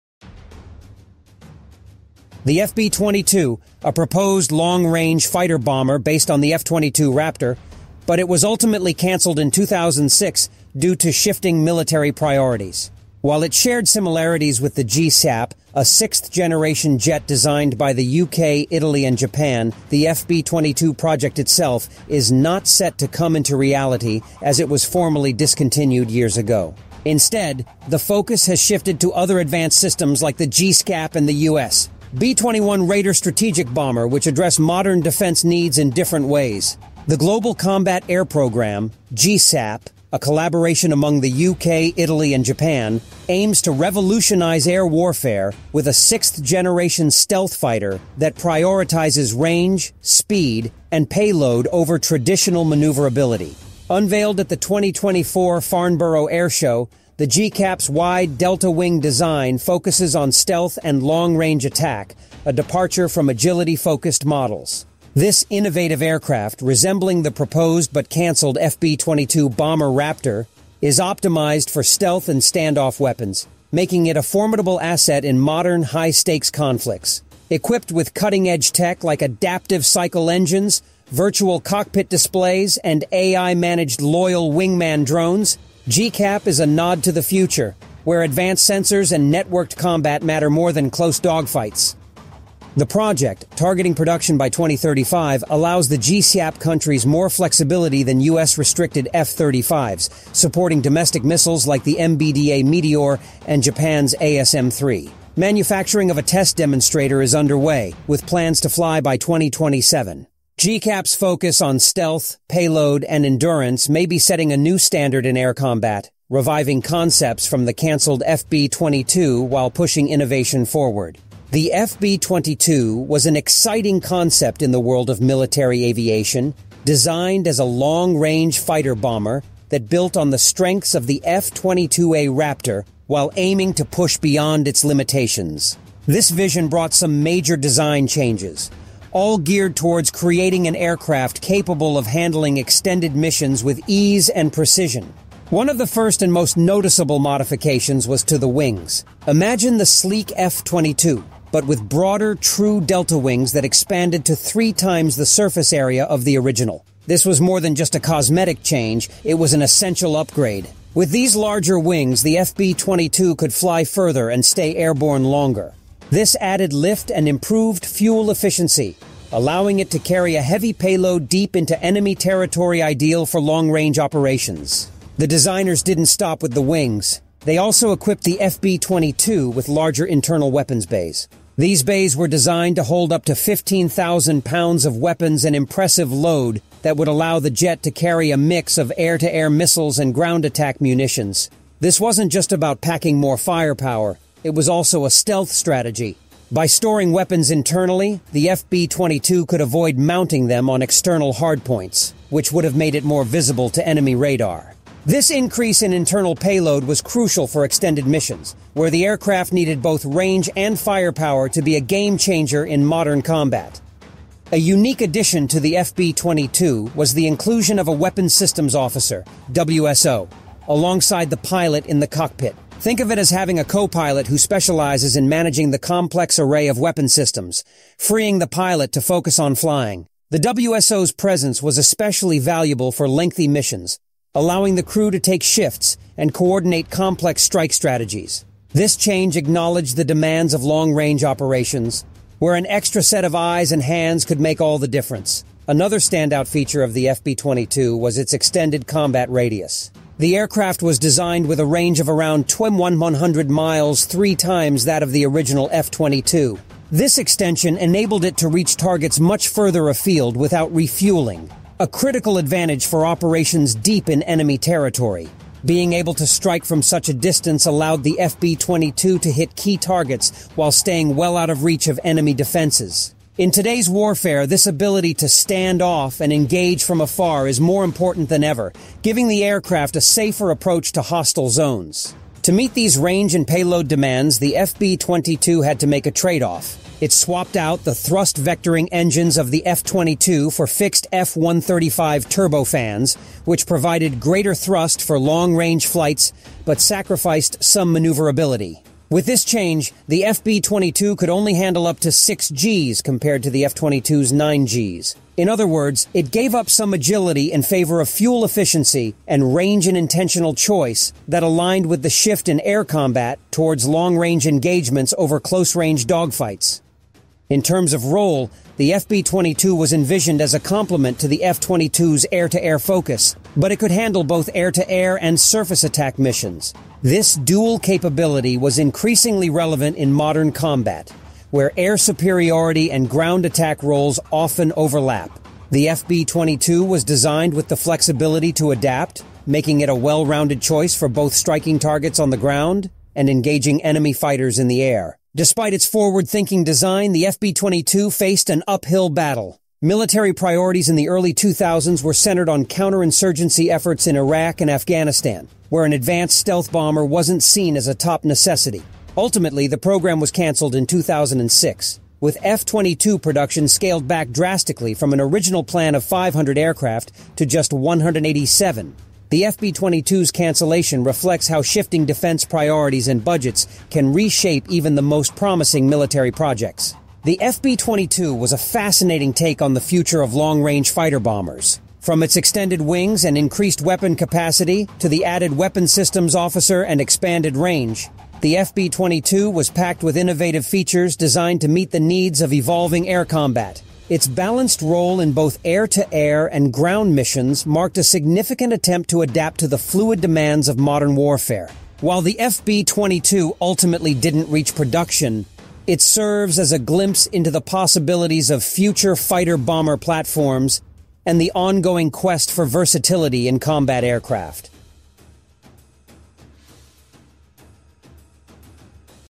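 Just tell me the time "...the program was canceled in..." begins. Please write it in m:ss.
5:59.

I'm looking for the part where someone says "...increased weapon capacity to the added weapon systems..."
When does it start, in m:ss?
6:23.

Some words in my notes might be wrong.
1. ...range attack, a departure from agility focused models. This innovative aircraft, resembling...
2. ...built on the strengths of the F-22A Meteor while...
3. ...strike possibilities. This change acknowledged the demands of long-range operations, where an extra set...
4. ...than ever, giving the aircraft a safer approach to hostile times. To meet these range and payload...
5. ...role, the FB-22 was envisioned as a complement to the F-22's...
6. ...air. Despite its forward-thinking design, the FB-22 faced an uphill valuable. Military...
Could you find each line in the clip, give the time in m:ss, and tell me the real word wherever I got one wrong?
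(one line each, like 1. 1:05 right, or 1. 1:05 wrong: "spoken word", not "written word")
1. 1:01 right
2. 2:09 wrong: "Raptor", not "Meteor"
3. 3:57 wrong: "strategies", not "possibilities"
4. 4:38 wrong: "zones", not "times"
5. 5:18 right
6. 5:44 wrong: "battle", not "valuable".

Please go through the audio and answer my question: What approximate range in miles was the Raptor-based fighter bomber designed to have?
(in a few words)
2,100 miles.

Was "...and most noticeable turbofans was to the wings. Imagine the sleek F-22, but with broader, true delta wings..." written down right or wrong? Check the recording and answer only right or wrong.
wrong.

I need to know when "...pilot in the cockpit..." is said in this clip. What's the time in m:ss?
3:41.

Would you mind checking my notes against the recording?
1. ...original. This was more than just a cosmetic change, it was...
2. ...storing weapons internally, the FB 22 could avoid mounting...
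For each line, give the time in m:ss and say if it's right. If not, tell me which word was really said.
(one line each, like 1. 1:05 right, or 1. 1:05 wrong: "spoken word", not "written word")
1. 2:36 right
2. 3:16 right.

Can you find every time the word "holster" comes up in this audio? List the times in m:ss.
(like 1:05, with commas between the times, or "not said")
not said.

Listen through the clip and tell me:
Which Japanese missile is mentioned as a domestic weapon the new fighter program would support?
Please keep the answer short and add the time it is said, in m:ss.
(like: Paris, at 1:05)
ASM-3, at 1:44.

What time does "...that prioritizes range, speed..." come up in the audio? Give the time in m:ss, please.
0:48.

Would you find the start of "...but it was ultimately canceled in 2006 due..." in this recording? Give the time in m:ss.
0:08.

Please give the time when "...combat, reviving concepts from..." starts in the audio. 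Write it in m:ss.
1:55.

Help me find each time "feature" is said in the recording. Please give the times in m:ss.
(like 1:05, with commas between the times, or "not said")
4:06, 6:30.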